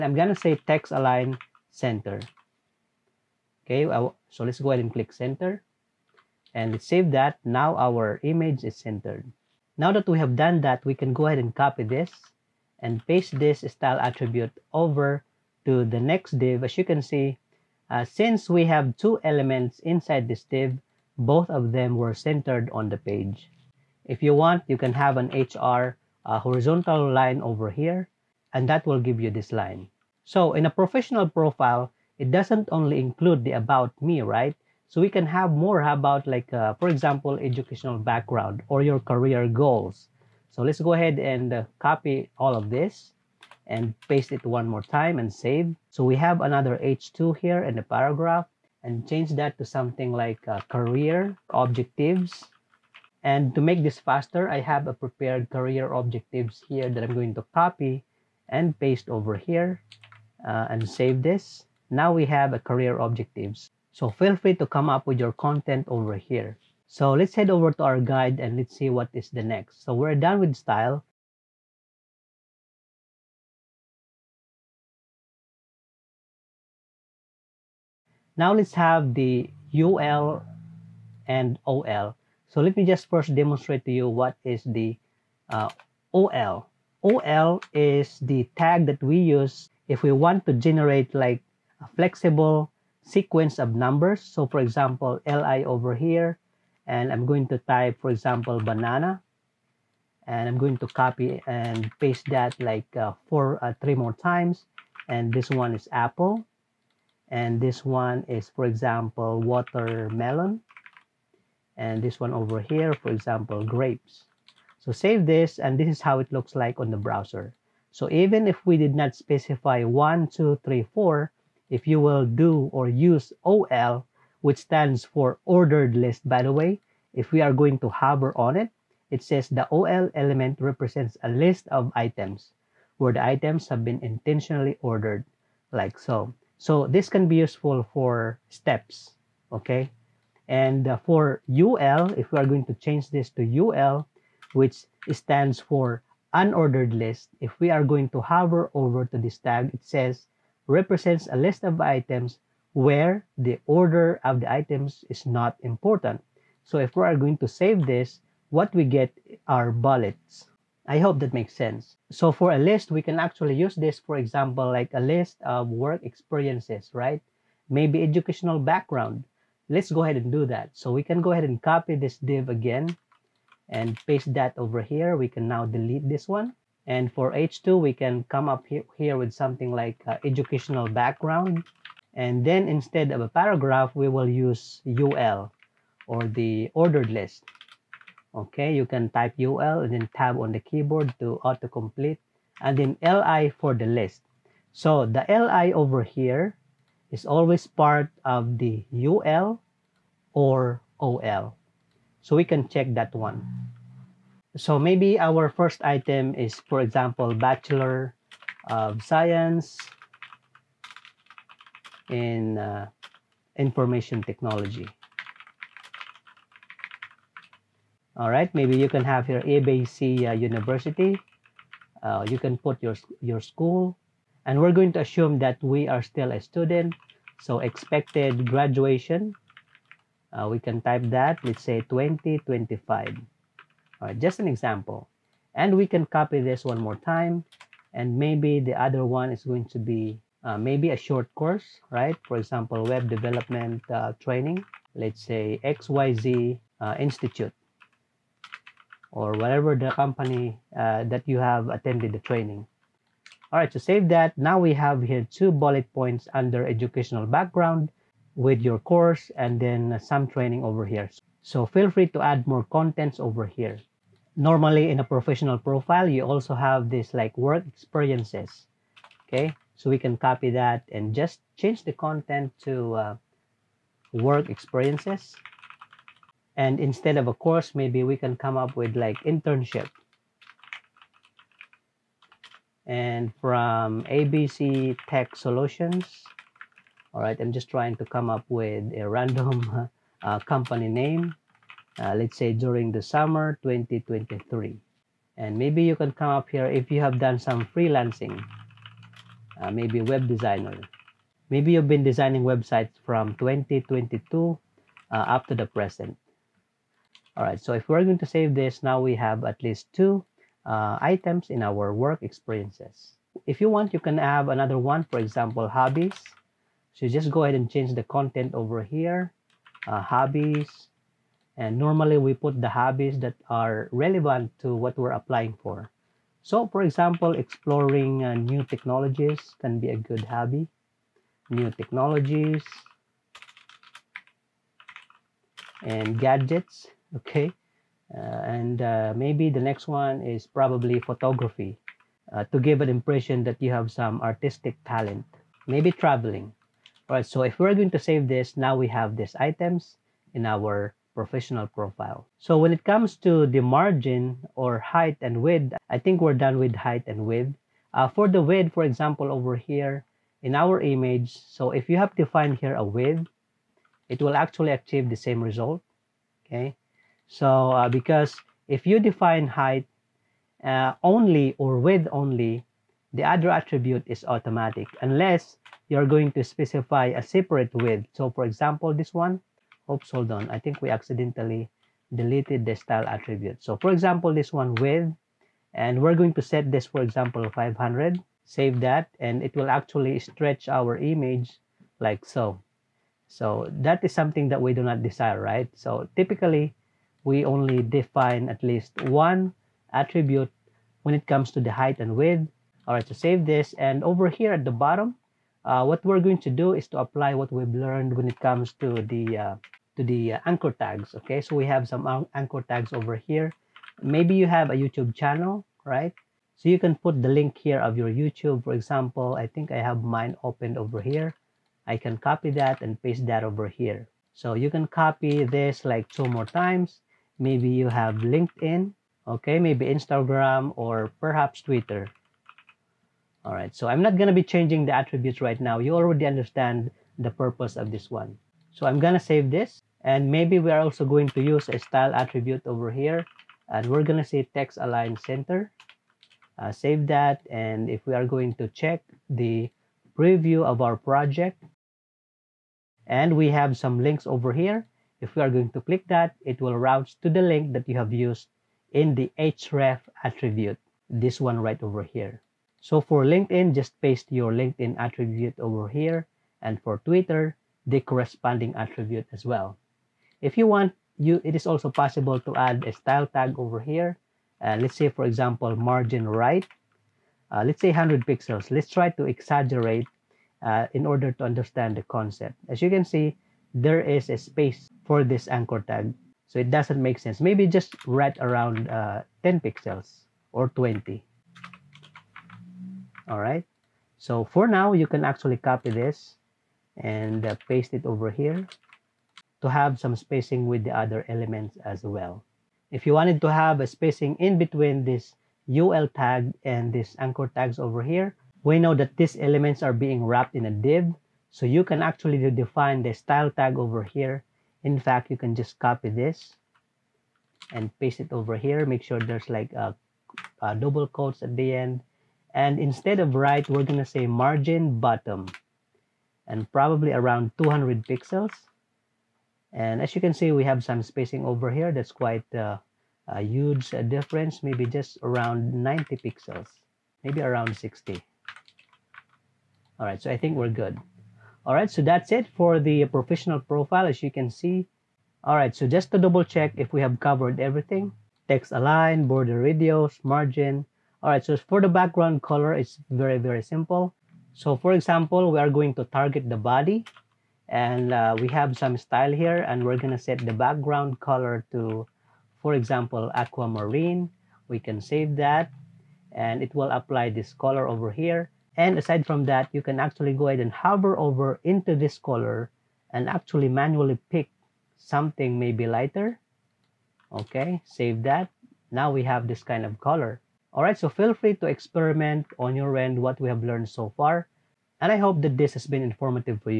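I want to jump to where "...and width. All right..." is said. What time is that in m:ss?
6:41.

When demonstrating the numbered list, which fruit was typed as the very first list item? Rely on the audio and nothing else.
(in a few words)
banana.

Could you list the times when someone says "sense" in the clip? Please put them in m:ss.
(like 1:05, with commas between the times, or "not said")
2:41, 8:07.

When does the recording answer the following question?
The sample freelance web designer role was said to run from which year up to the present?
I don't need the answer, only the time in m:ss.
5:03.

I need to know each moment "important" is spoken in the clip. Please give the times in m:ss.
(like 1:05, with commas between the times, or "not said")
2:35.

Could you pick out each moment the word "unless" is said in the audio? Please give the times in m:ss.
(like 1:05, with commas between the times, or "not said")
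6:15.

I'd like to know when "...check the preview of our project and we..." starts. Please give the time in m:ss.
7:28.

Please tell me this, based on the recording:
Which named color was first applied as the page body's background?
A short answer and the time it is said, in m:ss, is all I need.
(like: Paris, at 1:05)
aquamarine, at 9:23.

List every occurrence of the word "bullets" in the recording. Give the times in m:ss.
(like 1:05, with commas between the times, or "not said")
2:39, 4:15.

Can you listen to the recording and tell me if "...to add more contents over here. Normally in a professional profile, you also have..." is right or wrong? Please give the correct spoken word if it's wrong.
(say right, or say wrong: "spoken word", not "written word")
right.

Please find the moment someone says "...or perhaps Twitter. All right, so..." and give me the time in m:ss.
7:10.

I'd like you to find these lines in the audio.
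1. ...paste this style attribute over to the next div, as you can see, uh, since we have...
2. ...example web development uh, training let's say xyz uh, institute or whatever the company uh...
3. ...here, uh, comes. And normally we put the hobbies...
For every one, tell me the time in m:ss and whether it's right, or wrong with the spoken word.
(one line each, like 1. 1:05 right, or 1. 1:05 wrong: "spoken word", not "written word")
1. 0:13 right
2. 4:02 right
3. 5:18 wrong: "hobbies", not "comes".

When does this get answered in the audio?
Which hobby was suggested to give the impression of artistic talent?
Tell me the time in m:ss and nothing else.
5:40.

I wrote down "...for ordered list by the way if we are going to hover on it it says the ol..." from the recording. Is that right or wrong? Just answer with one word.
right.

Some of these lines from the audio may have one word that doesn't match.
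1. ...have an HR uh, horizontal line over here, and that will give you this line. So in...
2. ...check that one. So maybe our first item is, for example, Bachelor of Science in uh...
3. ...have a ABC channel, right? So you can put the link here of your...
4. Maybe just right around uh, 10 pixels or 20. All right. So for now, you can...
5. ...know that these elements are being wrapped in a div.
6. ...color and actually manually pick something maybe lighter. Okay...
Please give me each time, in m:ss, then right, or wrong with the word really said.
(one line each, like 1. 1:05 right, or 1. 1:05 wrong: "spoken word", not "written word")
1. 0:24 right
2. 3:22 right
3. 6:54 wrong: "YouTube", not "ABC"
4. 8:07 right
5. 8:28 right
6. 9:32 right.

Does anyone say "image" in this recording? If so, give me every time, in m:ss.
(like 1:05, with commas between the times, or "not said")
0:08, 6:00, 6:30.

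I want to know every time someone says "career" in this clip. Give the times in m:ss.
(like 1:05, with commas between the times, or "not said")
0:38, 0:50, 0:55, 1:02.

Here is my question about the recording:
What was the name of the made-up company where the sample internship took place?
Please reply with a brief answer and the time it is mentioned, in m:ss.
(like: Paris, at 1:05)
ABC Tech Solutions, at 4:44.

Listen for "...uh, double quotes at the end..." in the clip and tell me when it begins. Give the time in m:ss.
8:40.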